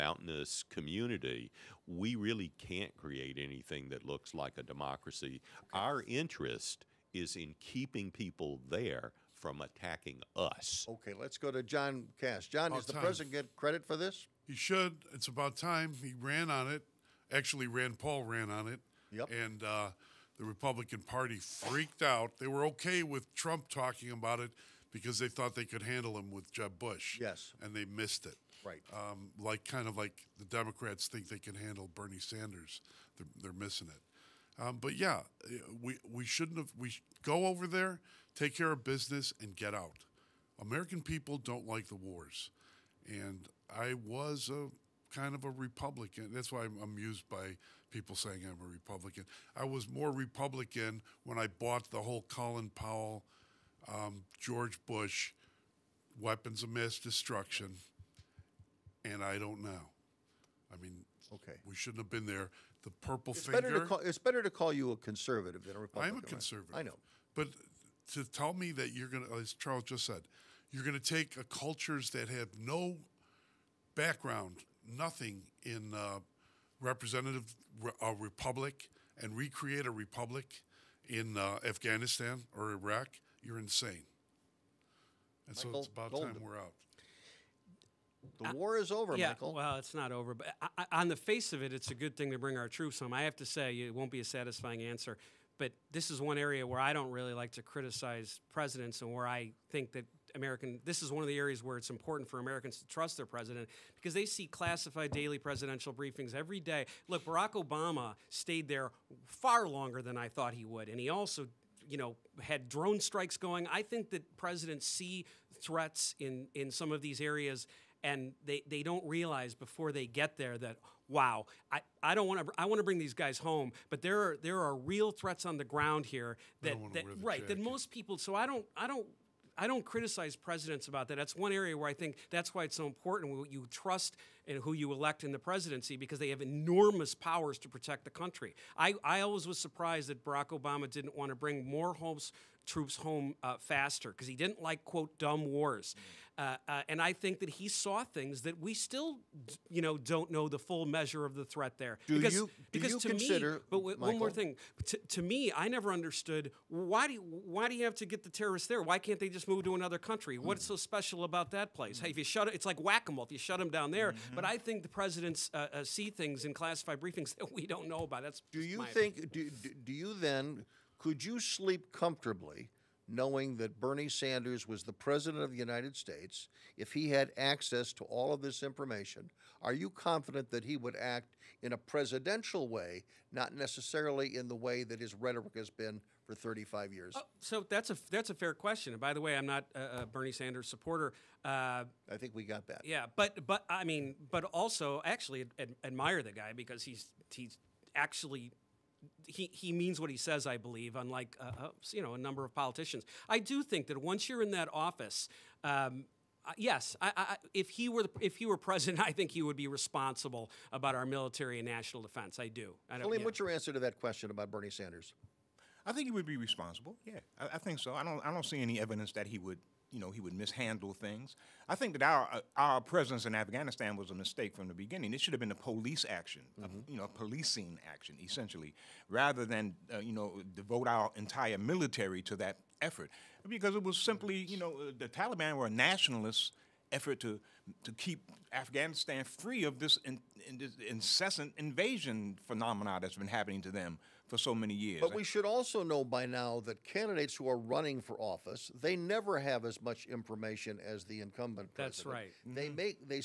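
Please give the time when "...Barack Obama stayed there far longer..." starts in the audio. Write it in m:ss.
1:47.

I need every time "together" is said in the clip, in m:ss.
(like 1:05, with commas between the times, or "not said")
not said.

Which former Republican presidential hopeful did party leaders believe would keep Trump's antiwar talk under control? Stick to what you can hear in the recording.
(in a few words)
Jeb Bush.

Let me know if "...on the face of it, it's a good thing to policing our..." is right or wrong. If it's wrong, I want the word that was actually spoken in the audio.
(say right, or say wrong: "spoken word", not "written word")
wrong: "bring", not "policing".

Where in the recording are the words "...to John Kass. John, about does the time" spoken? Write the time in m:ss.
0:11.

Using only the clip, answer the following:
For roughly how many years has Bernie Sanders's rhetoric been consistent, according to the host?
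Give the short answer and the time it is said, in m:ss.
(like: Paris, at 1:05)
35, at 3:06.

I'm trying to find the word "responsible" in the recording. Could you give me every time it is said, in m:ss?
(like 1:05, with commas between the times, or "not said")
3:29, 3:36.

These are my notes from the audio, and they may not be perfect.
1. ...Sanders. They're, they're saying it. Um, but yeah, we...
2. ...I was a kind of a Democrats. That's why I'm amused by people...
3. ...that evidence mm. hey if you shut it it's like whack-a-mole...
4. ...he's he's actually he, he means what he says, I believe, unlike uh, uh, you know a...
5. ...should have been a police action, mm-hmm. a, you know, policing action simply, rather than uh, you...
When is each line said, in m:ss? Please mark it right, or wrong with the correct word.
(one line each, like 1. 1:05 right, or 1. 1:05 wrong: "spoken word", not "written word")
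1. 0:32 wrong: "missing", not "saying"
2. 0:43 wrong: "Republican", not "Democrats"
3. 2:41 wrong: "place", not "evidence"
4. 3:16 right
5. 3:45 wrong: "essentially", not "simply".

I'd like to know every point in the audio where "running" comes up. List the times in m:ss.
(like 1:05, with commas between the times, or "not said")
4:07.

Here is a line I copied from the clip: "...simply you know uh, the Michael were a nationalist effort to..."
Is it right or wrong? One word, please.
wrong.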